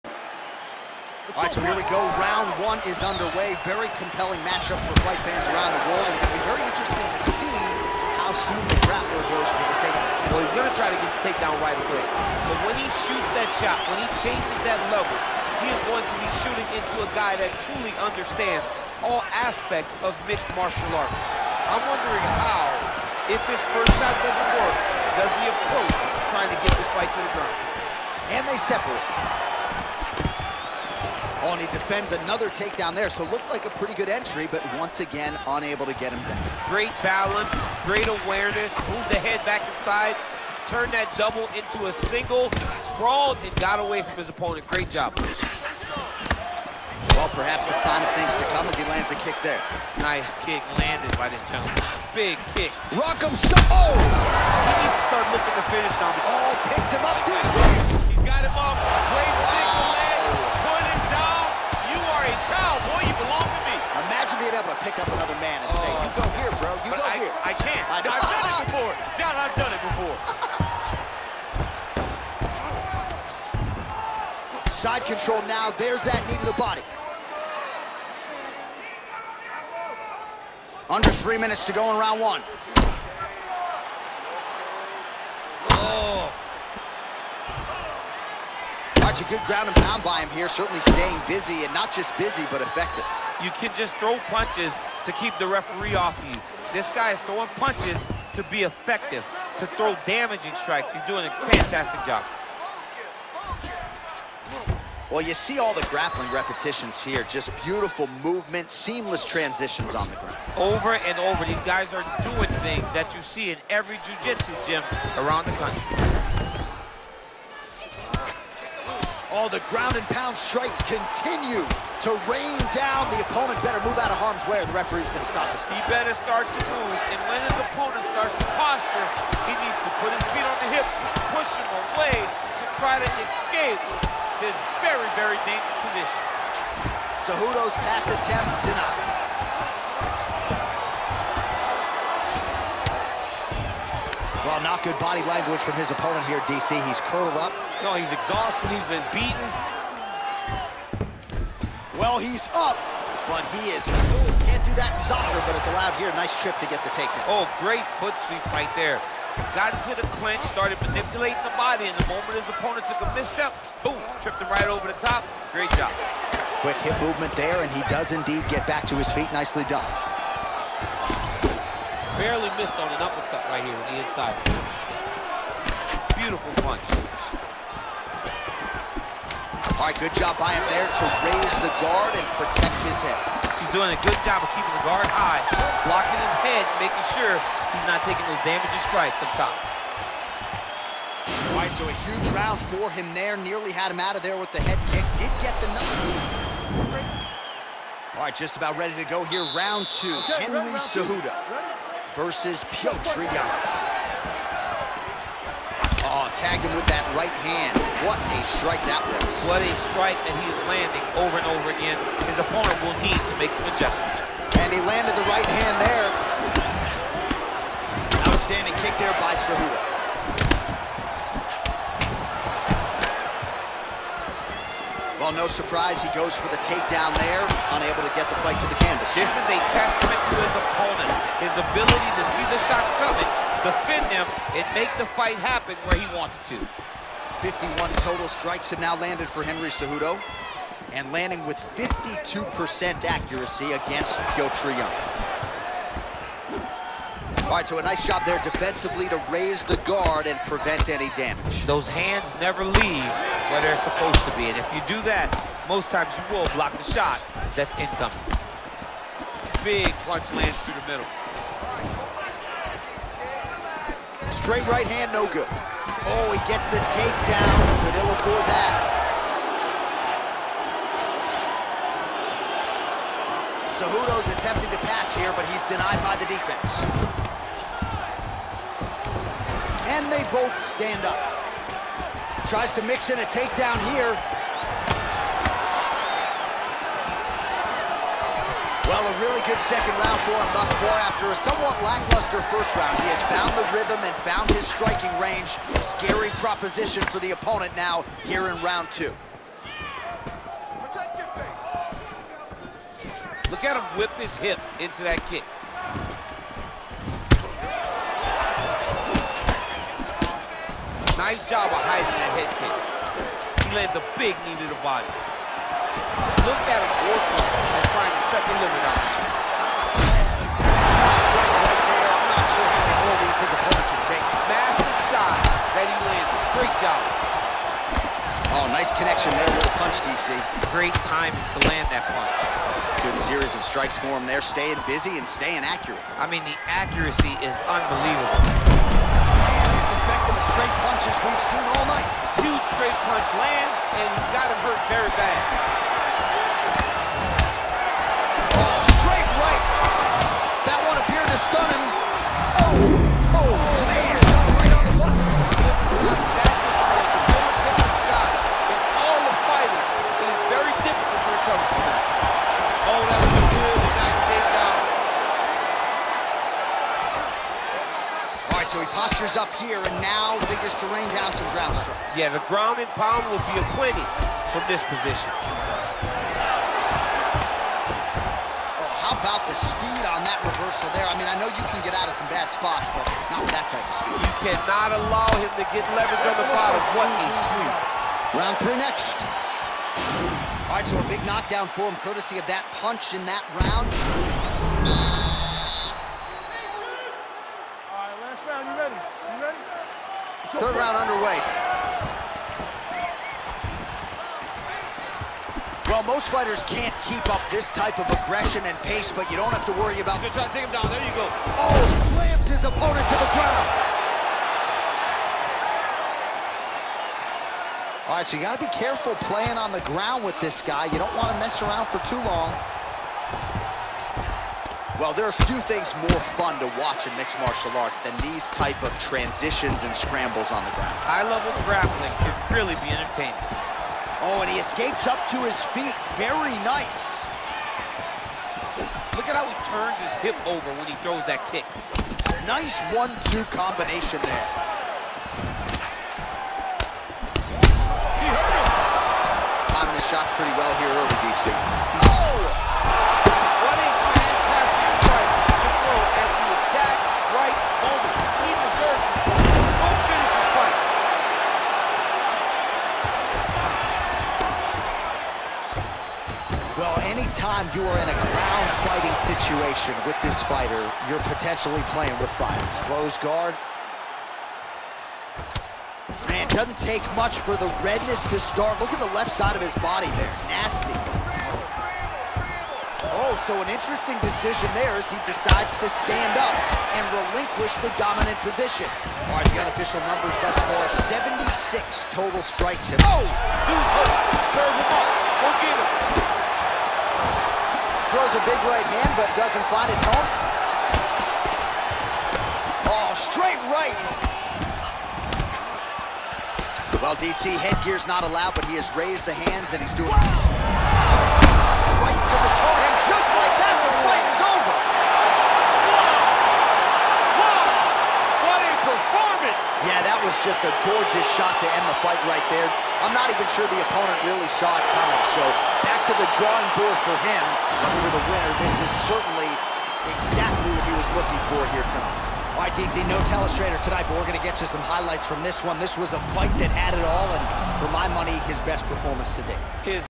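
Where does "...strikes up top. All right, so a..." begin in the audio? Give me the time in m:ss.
3:08.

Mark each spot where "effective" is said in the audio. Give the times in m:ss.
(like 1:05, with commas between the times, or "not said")
1:32, 1:38.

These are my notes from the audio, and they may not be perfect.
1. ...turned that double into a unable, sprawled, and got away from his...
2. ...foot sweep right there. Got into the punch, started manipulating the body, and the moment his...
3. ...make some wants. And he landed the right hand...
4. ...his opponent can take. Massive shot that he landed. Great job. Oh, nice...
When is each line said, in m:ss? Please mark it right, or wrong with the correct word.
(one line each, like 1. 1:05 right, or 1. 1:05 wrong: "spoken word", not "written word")
1. 0:40 wrong: "single", not "unable"
2. 2:38 wrong: "clinch", not "punch"
3. 3:33 wrong: "adjustments", not "wants"
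4. 5:23 right.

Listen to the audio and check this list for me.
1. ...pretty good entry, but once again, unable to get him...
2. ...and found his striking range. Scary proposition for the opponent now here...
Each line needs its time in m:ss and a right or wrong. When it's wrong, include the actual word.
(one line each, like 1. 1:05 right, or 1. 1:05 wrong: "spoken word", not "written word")
1. 0:33 right
2. 4:54 right.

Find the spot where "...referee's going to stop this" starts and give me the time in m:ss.
2:04.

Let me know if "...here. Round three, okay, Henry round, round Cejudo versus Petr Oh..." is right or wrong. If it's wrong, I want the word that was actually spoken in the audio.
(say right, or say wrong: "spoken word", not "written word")
wrong: "two", not "three".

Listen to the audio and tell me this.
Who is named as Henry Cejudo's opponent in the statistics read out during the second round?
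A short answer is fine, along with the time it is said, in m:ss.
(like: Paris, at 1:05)
Petr Yan, at 4:04.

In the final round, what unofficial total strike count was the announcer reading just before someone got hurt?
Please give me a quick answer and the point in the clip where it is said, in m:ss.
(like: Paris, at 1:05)
76, at 8:11.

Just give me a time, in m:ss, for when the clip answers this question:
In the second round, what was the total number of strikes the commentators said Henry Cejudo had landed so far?
3:57.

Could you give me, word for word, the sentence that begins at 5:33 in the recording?
Good series of strikes for him there, staying busy and staying accurate.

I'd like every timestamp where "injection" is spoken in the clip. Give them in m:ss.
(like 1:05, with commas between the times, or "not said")
not said.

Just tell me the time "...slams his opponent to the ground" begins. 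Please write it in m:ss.
6:52.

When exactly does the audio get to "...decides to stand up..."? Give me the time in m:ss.
8:05.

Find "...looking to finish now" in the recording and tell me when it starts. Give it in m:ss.
0:55.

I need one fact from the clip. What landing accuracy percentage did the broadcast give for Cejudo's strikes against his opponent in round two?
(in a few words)
52%.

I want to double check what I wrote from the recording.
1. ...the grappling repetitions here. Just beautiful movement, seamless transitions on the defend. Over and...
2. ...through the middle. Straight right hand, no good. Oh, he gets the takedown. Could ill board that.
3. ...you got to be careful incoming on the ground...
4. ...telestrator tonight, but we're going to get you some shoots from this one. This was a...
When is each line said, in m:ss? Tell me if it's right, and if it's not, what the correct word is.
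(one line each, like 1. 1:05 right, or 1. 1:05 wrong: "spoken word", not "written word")
1. 1:45 wrong: "ground", not "defend"
2. 4:20 wrong: "afford", not "board"
3. 6:58 wrong: "playing", not "incoming"
4. 8:53 wrong: "highlights", not "shoots".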